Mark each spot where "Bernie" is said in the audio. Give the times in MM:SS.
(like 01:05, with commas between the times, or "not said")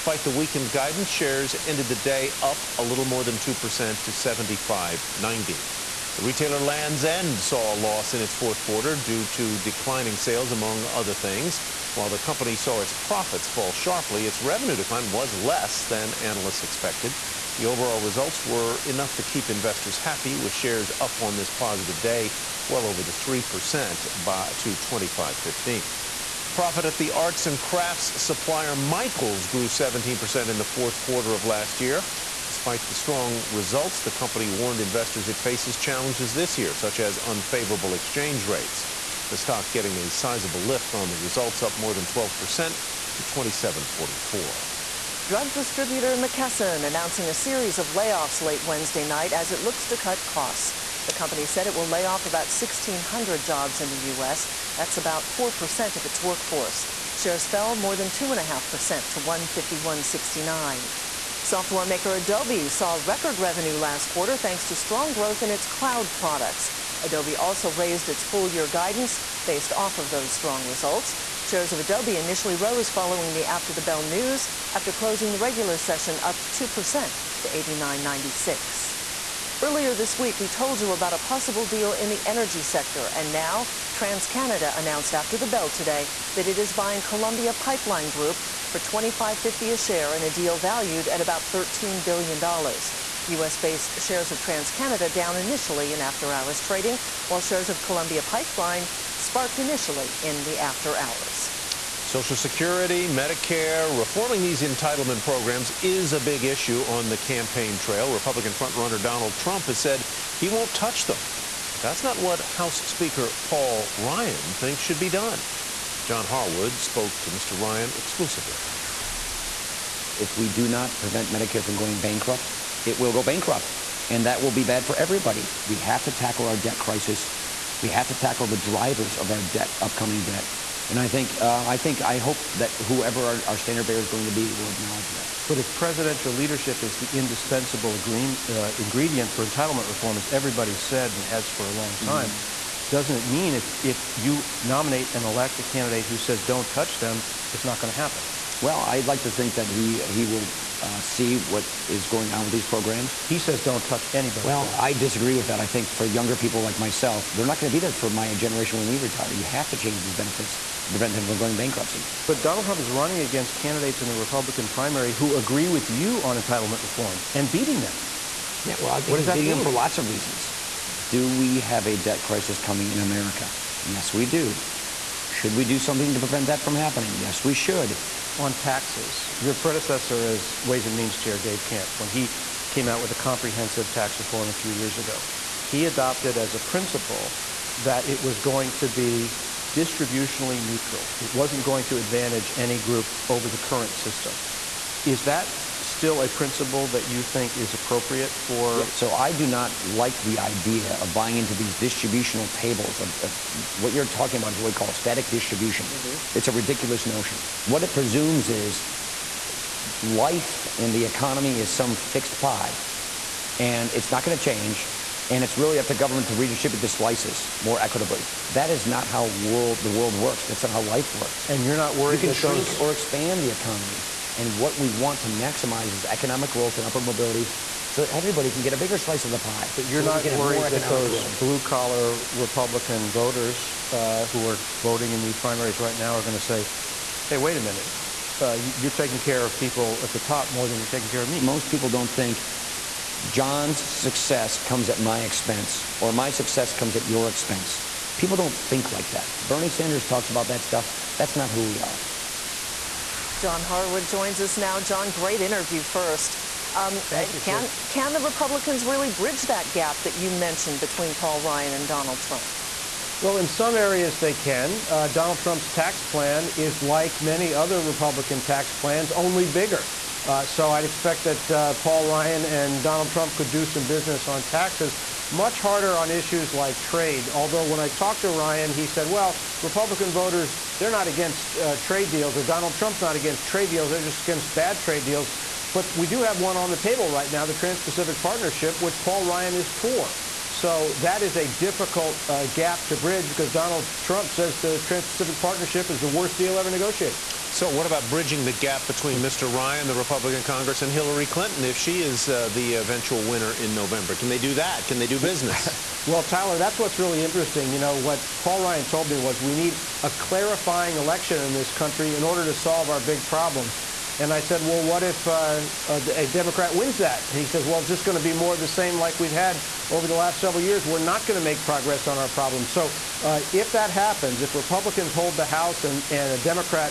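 04:09.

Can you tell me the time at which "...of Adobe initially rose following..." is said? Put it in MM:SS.
01:11.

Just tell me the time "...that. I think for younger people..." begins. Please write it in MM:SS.
02:35.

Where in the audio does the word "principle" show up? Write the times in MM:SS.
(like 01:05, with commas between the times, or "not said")
03:06, 03:16.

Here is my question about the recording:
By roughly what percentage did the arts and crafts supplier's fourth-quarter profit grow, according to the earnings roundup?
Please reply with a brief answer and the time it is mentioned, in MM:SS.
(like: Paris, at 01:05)
17%, at 00:29.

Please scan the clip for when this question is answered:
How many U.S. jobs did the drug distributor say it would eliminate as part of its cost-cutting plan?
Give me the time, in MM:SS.
00:52.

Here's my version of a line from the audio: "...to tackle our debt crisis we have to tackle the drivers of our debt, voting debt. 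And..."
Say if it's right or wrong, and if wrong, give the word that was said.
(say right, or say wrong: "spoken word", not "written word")
wrong: "upcoming", not "voting".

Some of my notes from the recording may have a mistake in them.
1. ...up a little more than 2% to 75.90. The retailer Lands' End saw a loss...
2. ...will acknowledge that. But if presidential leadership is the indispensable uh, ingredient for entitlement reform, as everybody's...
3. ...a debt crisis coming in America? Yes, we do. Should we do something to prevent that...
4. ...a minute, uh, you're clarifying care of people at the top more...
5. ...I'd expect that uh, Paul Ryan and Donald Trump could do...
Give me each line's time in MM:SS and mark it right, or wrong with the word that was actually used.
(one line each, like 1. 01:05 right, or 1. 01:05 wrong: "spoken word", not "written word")
1. 00:02 right
2. 02:14 right
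3. 02:51 right
4. 03:57 wrong: "taking", not "clarifying"
5. 04:30 right.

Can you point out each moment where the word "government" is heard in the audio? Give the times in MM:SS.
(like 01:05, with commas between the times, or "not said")
03:35.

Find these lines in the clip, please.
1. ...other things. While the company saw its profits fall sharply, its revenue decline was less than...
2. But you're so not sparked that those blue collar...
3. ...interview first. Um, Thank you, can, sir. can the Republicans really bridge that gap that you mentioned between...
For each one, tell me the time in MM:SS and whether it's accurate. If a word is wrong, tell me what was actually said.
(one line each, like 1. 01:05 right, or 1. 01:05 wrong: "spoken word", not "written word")
1. 00:10 right
2. 03:49 wrong: "worried", not "sparked"
3. 04:15 right.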